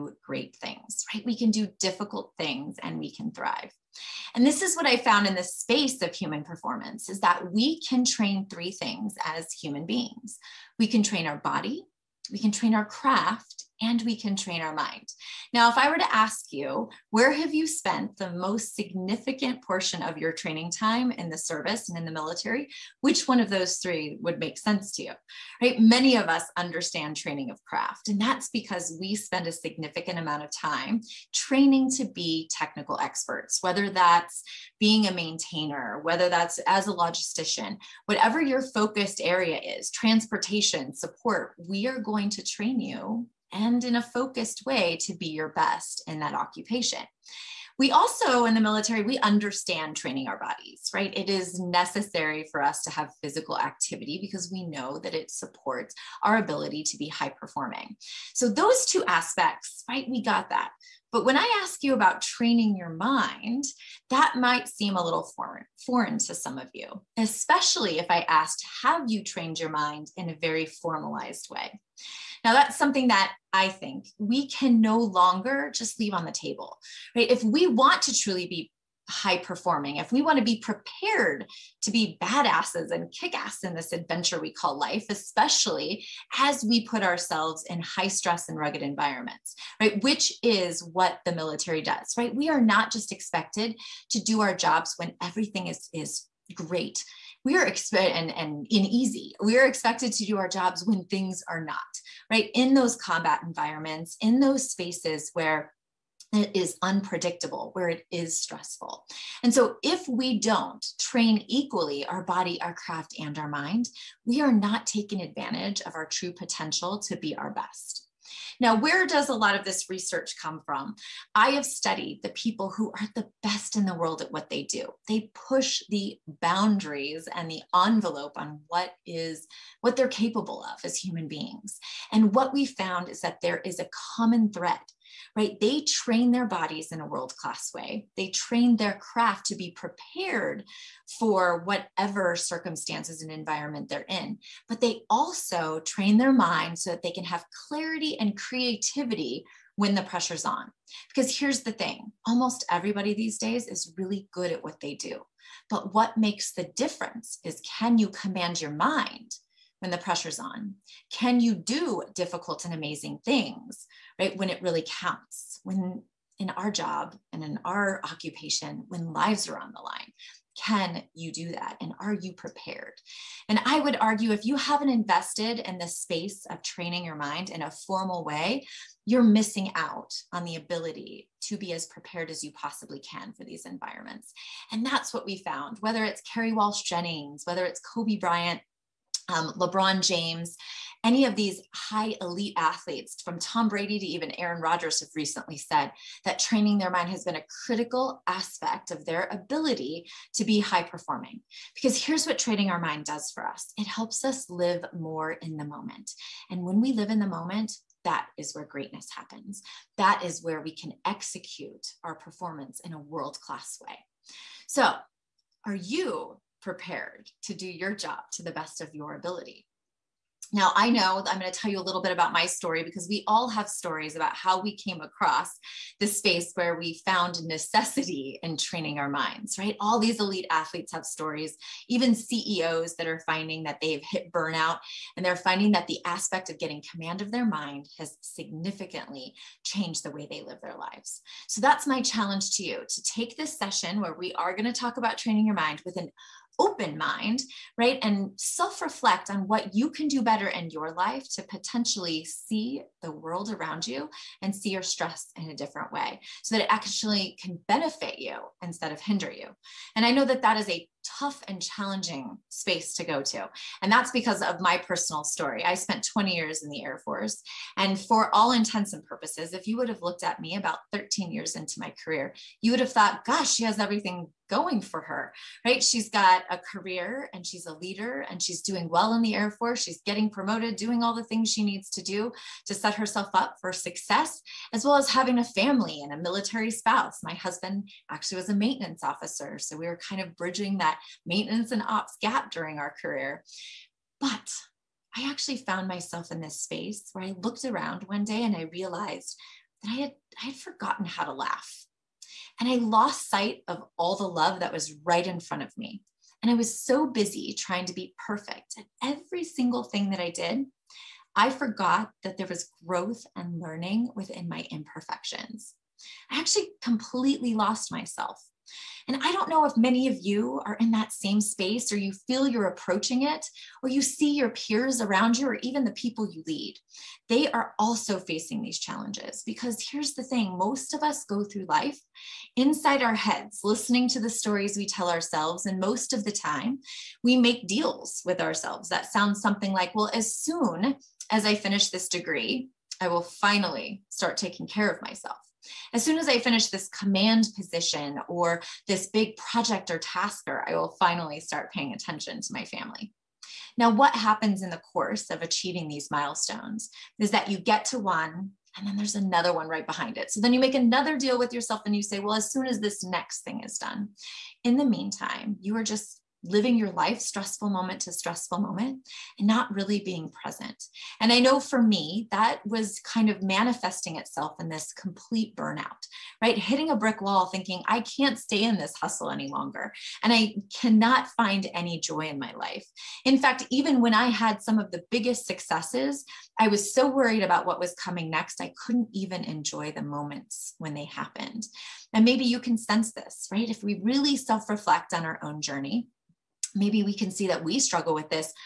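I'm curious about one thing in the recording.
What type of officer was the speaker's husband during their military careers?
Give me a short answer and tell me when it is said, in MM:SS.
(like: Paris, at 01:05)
Maintenance officer, at 04:48.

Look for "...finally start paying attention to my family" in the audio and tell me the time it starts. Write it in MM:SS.
05:50.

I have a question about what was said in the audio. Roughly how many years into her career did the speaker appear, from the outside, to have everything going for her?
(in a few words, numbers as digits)
13.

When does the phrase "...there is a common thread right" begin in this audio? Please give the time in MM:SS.
02:13.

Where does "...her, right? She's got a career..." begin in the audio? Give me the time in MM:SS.
04:35.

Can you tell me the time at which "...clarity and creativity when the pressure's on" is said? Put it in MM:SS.
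02:27.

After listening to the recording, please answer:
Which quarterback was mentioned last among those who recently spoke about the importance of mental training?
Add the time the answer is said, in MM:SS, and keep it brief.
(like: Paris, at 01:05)
Aaron Rodgers, at 03:14.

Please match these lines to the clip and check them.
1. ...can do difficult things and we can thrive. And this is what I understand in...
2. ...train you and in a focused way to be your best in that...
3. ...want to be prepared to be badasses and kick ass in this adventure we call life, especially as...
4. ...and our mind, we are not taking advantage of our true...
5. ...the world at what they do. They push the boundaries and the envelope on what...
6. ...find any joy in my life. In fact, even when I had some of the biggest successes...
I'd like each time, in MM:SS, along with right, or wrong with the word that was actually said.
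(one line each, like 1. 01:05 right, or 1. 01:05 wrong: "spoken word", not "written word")
1. 00:01 wrong: "found", not "understand"
2. 00:42 right
3. 01:20 right
4. 01:53 right
5. 02:03 right
6. 06:21 right.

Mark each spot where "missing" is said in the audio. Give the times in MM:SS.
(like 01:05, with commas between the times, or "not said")
02:59.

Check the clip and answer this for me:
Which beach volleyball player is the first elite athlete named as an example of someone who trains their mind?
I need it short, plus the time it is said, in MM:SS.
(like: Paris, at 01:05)
Kerry Walsh Jennings, at 03:06.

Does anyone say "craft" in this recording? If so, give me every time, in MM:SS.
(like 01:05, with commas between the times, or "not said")
00:12, 00:27, 01:52, 02:18.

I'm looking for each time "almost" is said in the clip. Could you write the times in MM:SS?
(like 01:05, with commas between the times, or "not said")
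02:32.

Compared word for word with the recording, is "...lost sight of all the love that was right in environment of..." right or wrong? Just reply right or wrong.
wrong.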